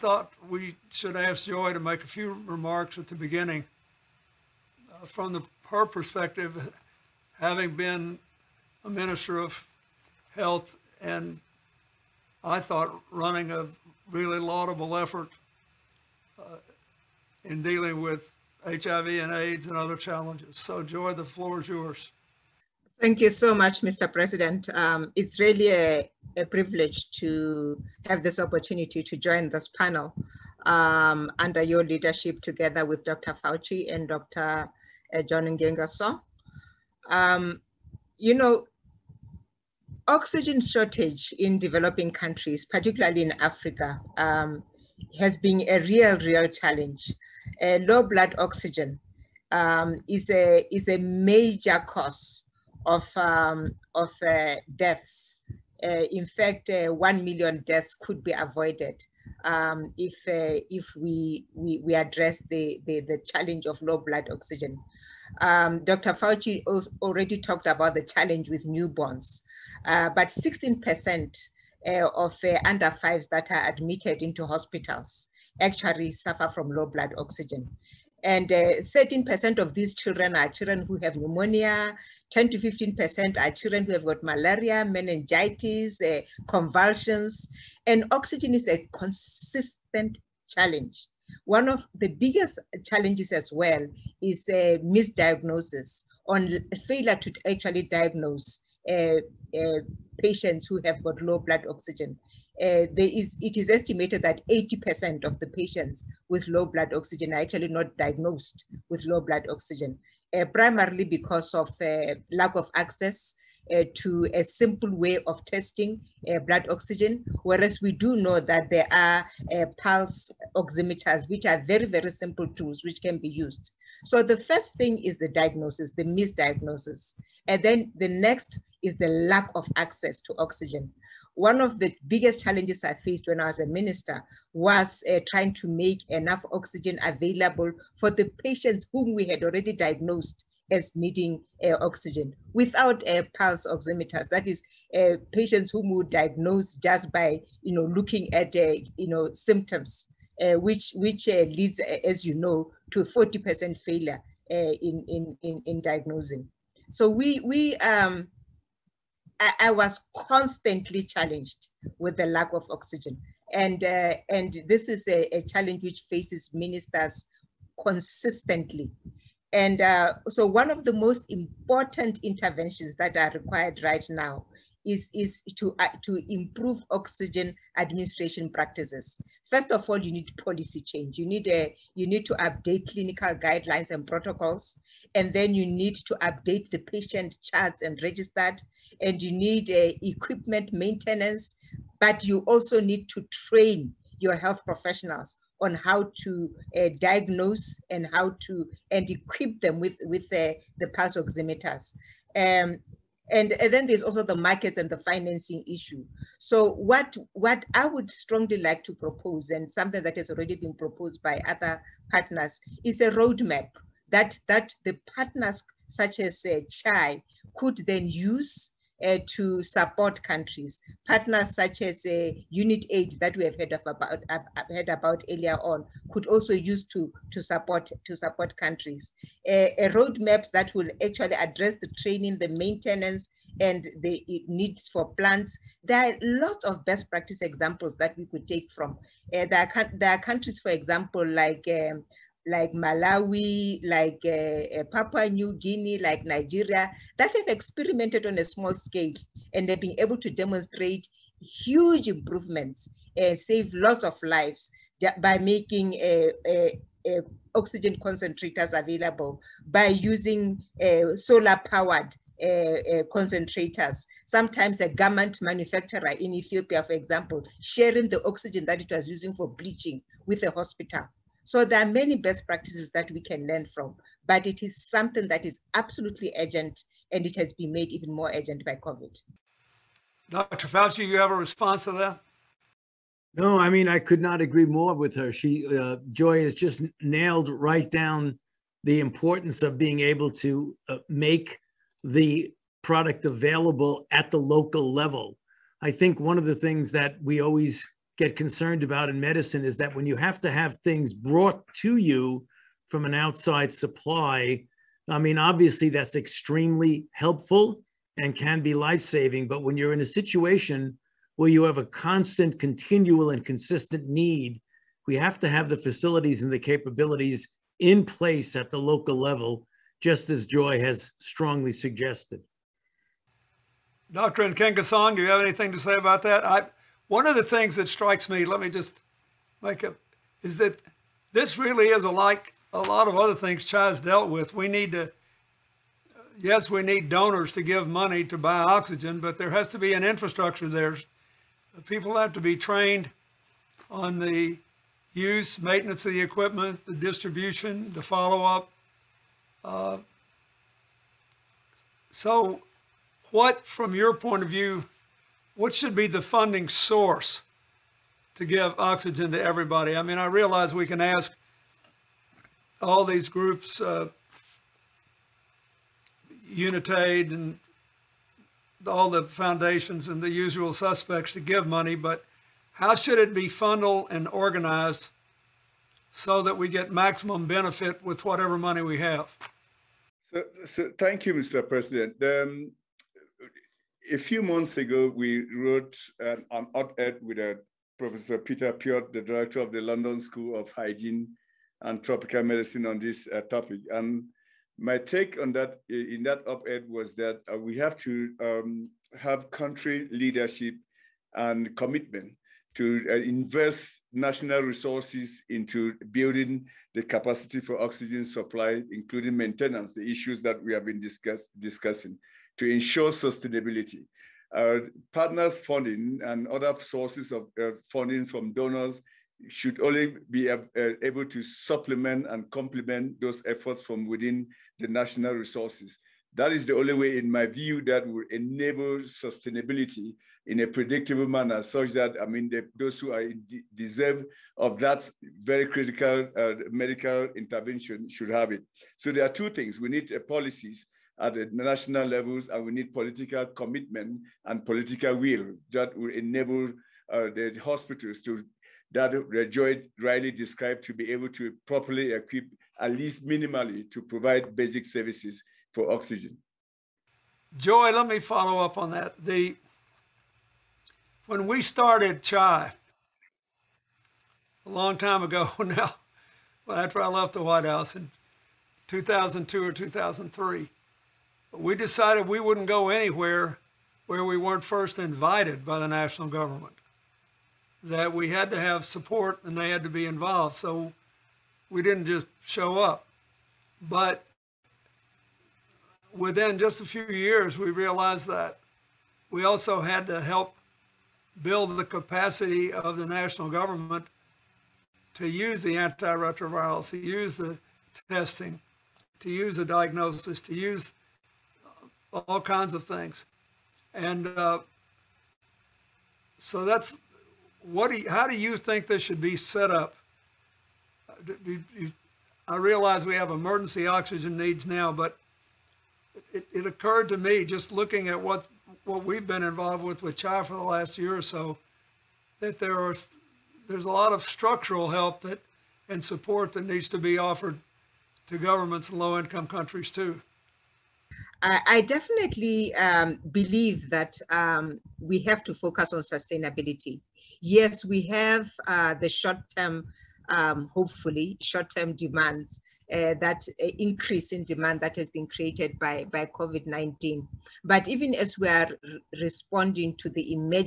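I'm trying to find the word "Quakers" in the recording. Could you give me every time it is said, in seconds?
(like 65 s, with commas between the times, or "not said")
not said.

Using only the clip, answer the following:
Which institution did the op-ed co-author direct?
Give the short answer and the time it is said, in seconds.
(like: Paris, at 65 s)
London School of Hygiene and Tropical Medicine, at 389 s.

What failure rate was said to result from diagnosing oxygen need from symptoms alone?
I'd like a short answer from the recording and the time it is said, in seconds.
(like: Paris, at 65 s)
40%, at 153 s.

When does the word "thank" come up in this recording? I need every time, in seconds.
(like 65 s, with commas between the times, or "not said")
22 s, 380 s.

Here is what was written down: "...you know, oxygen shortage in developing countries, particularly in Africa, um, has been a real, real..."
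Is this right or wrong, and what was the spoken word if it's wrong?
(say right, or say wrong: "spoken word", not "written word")
right.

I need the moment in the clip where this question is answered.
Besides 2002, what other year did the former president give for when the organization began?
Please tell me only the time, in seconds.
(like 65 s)
469 s.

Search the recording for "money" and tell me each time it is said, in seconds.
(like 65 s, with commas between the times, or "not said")
337 s, 371 s, 378 s.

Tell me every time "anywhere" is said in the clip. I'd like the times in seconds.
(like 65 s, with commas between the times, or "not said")
472 s.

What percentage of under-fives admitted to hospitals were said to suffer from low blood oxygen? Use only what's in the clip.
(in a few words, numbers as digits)
16%.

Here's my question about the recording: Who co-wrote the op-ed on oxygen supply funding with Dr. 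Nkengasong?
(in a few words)
Peter Piot.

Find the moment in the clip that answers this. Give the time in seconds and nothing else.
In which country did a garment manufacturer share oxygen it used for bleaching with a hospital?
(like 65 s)
266 s.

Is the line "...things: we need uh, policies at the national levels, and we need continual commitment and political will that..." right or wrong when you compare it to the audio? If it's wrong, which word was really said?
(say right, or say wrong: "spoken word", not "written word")
wrong: "political", not "continual".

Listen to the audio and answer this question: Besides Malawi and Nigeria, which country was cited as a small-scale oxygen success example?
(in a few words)
Papua New Guinea.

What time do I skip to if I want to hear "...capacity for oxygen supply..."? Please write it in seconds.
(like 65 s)
407 s.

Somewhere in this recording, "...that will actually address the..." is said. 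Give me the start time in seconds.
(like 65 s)
230 s.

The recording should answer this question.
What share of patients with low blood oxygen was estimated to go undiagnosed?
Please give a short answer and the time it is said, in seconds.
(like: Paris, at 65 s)
80%, at 104 s.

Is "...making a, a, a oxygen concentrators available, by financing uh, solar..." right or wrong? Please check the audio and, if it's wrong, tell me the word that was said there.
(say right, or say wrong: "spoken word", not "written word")
wrong: "using", not "financing".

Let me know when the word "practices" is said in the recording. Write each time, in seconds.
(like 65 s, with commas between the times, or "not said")
178 s, 237 s, 272 s.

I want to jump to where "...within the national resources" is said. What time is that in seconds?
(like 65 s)
424 s.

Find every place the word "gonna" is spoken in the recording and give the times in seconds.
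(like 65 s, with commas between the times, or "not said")
not said.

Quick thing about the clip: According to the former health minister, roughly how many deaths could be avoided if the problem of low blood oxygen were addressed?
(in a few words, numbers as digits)
1 million.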